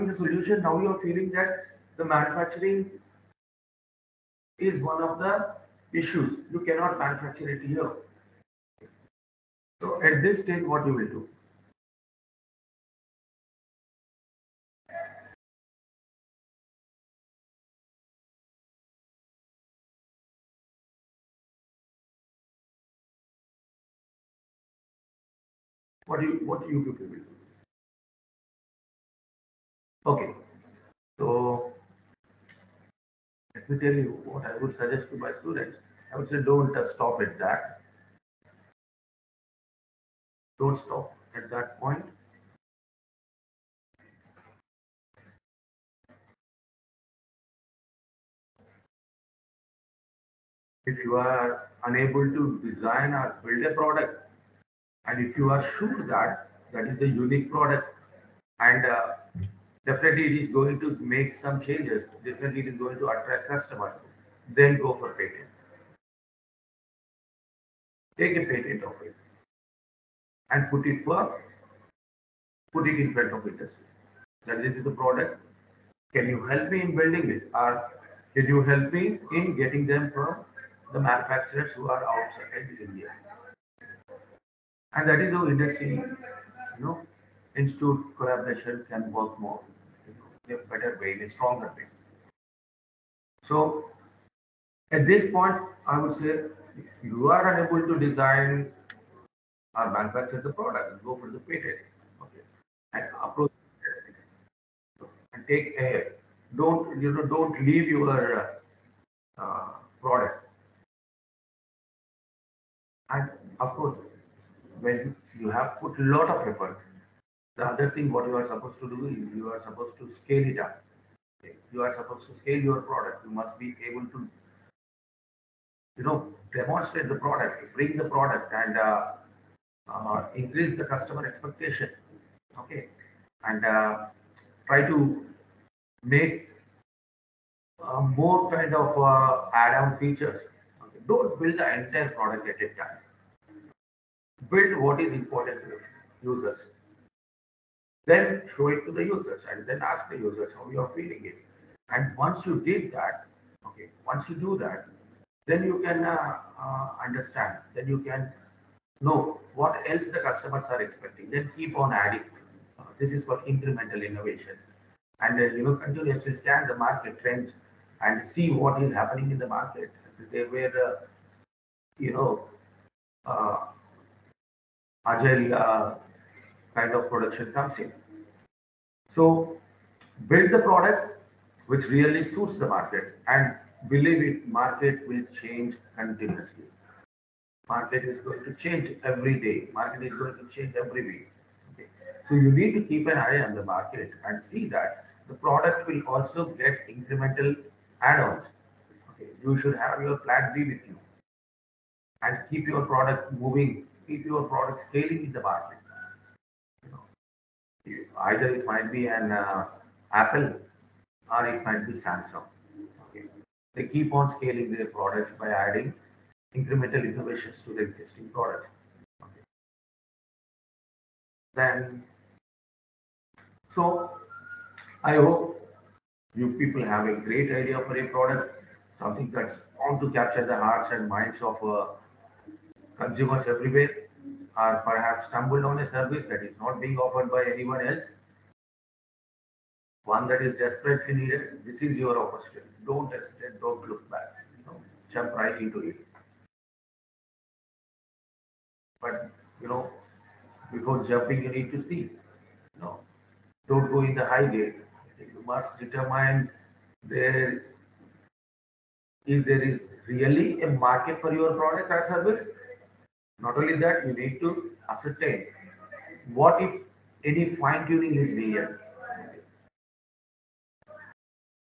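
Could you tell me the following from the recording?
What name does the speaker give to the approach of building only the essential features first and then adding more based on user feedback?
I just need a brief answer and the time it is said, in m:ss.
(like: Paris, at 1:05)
Incremental innovation, at 2:43.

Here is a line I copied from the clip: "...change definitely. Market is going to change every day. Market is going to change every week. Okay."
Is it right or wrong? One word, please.
wrong.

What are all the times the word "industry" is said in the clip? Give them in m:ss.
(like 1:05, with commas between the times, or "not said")
1:13, 1:25.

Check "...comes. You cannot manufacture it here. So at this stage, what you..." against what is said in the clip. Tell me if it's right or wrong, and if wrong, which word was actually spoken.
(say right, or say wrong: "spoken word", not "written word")
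wrong: "issues", not "comes".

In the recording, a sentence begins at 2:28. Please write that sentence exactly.
Then show it to the users and then ask the users how you are feeling it.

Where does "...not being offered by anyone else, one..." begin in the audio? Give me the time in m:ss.
3:56.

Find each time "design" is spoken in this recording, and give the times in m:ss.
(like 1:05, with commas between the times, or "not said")
0:52, 1:37.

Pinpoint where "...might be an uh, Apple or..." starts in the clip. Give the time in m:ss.
3:28.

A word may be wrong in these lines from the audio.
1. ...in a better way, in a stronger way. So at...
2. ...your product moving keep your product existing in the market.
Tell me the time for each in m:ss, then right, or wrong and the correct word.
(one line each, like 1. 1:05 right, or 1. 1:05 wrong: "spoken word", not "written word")
1. 1:30 right
2. 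3:22 wrong: "scaling", not "existing".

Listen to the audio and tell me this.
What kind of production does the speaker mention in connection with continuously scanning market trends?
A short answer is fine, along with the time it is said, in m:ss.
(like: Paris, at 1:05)
Agile, at 2:55.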